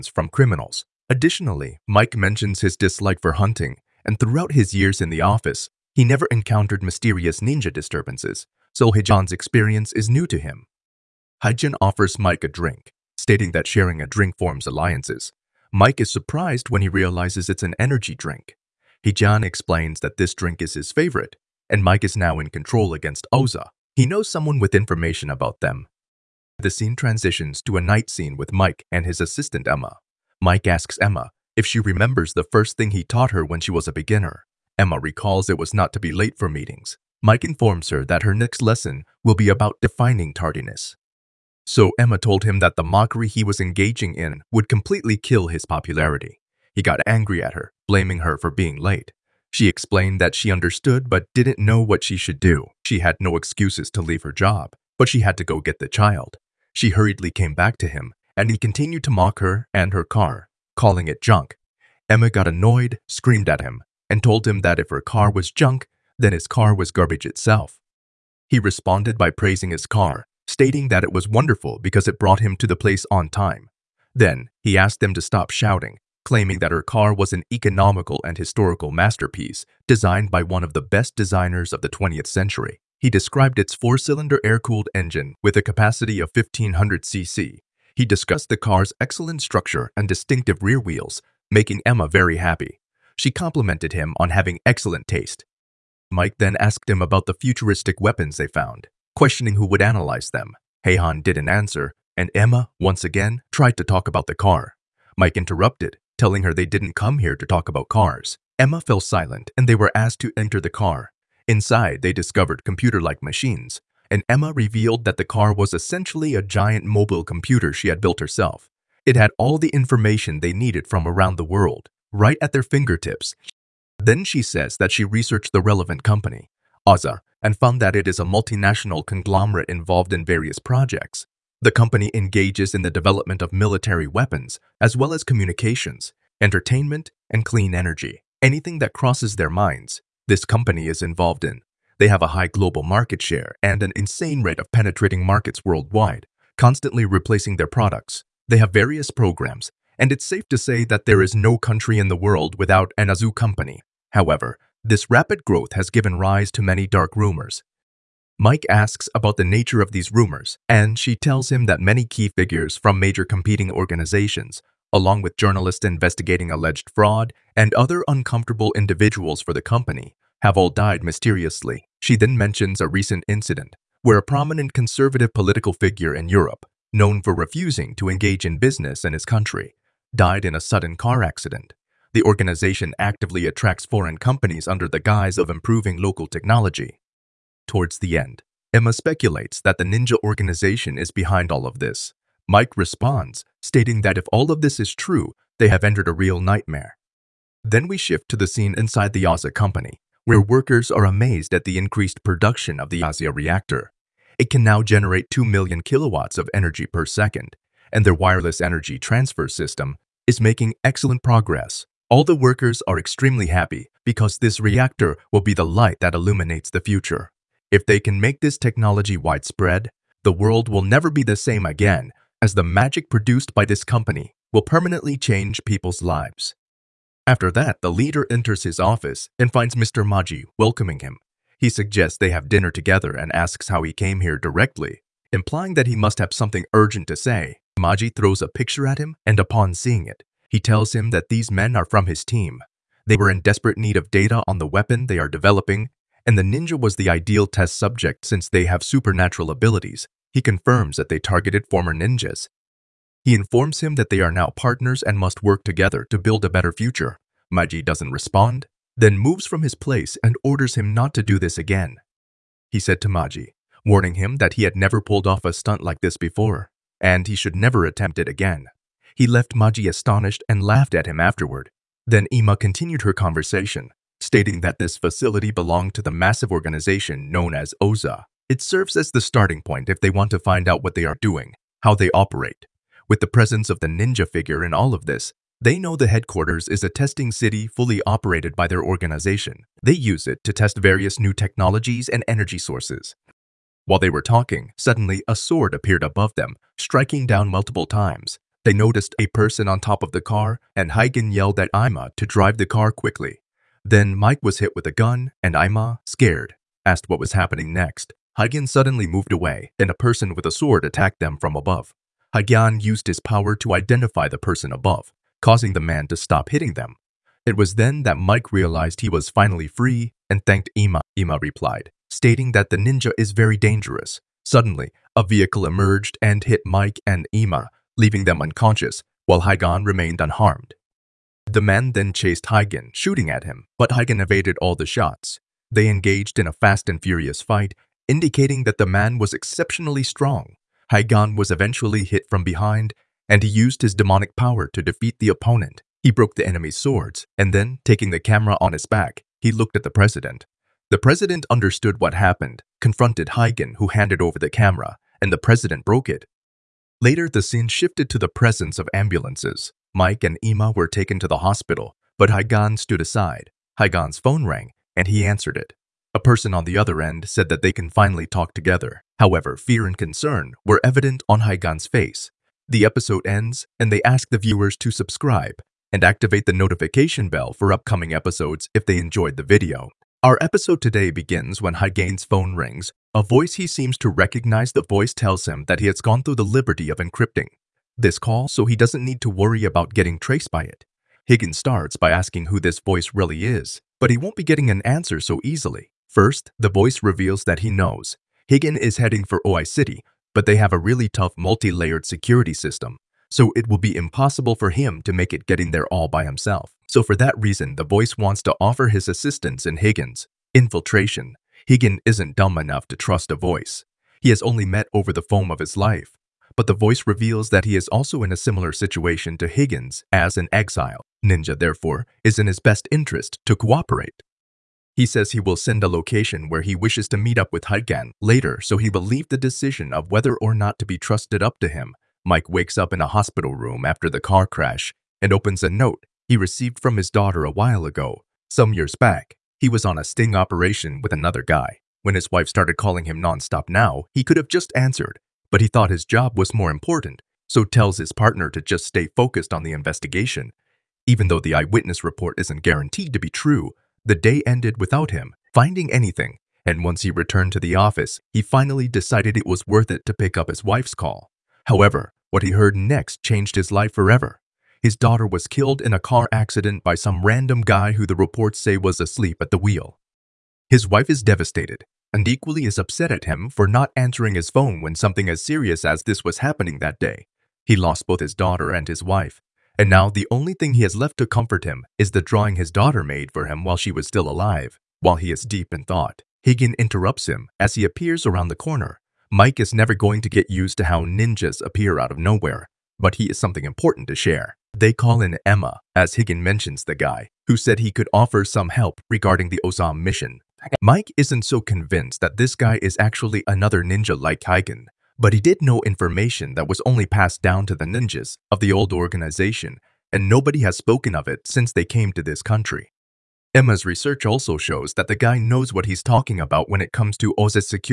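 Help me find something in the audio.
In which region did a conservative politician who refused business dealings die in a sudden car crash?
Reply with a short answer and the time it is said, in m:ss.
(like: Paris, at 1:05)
Europe, at 2:56.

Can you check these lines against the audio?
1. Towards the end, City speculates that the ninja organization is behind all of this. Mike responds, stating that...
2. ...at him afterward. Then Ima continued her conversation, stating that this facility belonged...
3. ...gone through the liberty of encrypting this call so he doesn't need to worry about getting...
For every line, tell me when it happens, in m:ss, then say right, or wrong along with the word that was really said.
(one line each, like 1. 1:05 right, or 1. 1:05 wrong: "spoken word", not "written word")
1. 3:07 wrong: "Emma", not "City"
2. 4:30 right
3. 6:25 right.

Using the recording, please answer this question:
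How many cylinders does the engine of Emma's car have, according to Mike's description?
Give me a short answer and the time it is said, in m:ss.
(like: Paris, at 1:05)
4, at 1:23.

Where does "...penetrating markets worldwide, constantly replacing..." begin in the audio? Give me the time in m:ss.
2:24.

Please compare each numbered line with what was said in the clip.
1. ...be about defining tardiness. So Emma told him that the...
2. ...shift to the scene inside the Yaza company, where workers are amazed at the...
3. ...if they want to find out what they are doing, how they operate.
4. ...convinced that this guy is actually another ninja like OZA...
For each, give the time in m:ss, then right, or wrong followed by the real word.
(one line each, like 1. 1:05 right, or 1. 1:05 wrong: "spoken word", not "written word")
1. 0:39 right
2. 3:17 right
3. 4:39 right
4. 8:21 wrong: "Higgin", not "OZA".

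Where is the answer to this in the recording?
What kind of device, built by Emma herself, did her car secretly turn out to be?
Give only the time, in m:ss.
1:56.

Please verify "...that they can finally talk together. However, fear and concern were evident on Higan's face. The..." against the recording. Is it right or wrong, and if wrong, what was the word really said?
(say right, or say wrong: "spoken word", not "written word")
right.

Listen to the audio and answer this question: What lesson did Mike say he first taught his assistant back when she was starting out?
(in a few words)
Not to be late for meetings.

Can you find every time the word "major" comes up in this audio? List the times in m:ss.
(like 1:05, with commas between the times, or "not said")
2:42.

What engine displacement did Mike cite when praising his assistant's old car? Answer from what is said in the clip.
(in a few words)
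1500 cc.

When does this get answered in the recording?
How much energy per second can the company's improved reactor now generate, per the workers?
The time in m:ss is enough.
3:25.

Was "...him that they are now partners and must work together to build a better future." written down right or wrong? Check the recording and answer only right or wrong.
right.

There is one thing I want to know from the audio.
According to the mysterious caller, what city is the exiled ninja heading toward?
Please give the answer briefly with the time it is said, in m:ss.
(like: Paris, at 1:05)
OI City, at 6:39.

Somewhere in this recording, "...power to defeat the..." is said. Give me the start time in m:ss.
5:44.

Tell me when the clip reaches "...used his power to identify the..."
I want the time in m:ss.
5:12.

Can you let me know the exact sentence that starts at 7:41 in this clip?
However, what he heard next changed his life forever.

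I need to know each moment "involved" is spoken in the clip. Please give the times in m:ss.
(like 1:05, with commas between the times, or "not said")
2:09, 2:21.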